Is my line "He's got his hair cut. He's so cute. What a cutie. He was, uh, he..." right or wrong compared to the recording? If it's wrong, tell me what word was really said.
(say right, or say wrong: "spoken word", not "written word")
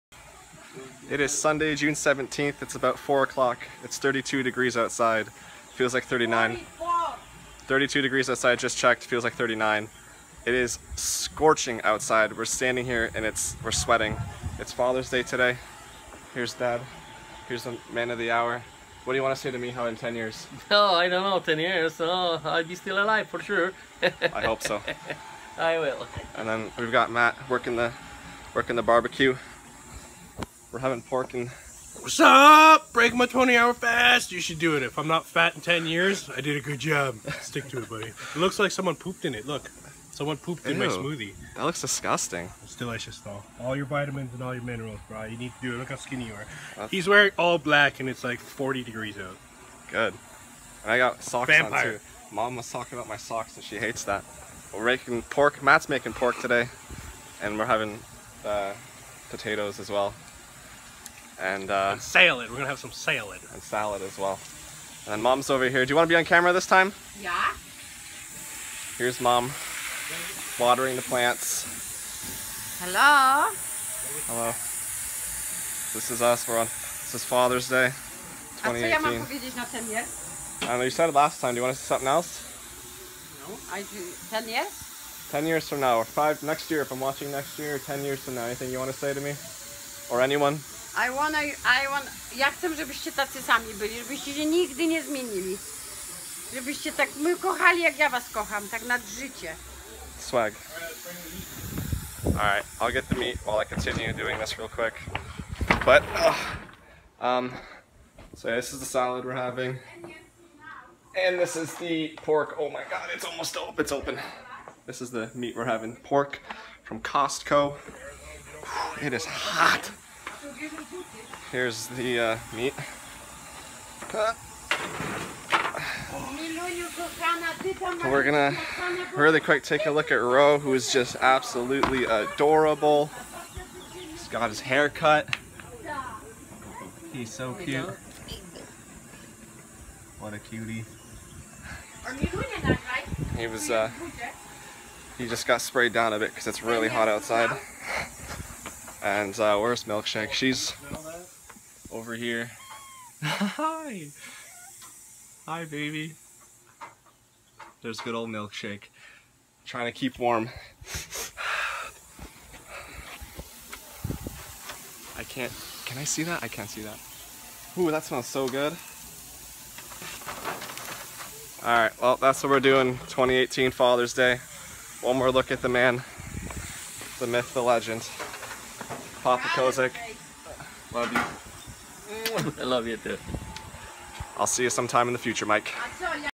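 right.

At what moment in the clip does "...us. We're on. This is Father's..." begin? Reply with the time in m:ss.
1:16.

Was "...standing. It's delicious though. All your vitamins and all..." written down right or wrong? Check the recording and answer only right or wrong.
wrong.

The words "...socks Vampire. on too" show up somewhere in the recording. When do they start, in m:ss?
0:51.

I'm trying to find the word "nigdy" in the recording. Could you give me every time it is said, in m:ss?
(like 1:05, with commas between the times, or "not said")
1:34.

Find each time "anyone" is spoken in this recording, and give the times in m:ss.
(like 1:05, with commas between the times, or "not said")
1:30.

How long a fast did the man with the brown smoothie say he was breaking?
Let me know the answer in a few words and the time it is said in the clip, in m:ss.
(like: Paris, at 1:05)
20 hours, at 0:33.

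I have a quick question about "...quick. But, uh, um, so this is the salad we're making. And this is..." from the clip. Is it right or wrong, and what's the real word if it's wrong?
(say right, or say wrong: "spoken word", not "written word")
wrong: "having", not "making".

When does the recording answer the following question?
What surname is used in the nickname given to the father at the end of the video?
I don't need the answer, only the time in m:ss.
2:59.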